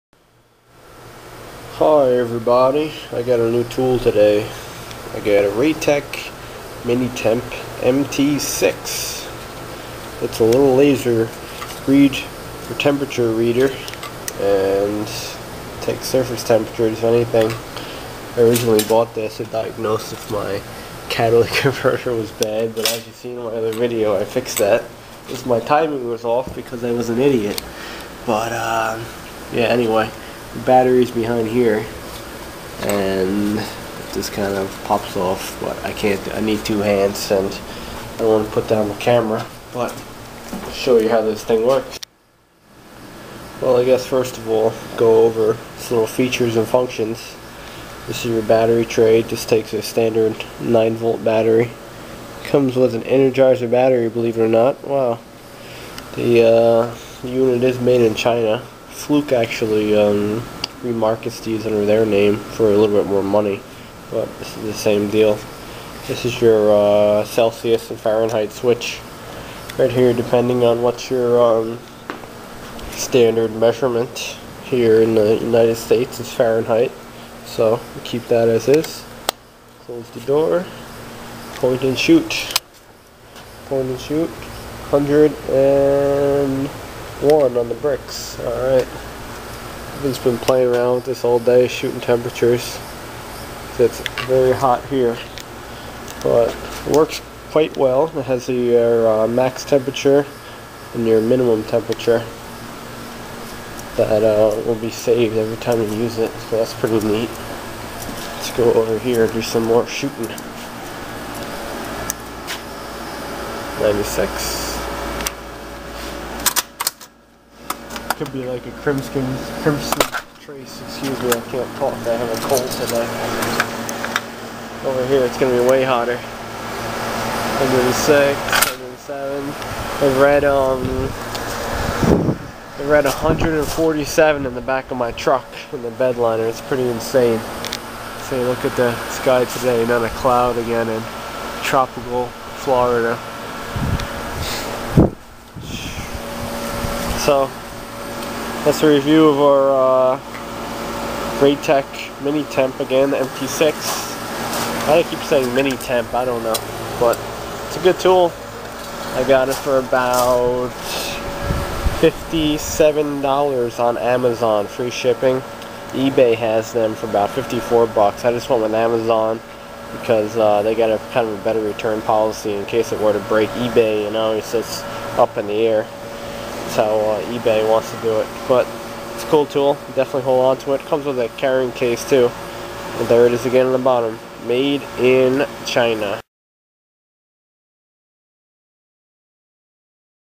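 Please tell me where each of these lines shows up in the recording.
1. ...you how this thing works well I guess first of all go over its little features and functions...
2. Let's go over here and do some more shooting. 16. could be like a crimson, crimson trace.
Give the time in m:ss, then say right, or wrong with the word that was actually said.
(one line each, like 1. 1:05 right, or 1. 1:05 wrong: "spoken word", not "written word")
1. 0:40 right
2. 1:48 wrong: "96", not "16".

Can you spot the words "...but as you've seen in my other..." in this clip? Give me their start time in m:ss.
0:22.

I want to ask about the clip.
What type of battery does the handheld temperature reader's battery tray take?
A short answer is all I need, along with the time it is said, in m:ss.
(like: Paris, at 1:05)
9 volt, at 0:50.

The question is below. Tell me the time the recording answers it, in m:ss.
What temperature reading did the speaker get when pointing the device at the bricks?
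1:24.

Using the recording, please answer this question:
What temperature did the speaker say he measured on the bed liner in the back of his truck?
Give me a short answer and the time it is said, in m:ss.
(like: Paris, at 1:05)
147, at 2:13.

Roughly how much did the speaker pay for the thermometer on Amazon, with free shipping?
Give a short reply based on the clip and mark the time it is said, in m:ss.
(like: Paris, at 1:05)
$57, at 2:42.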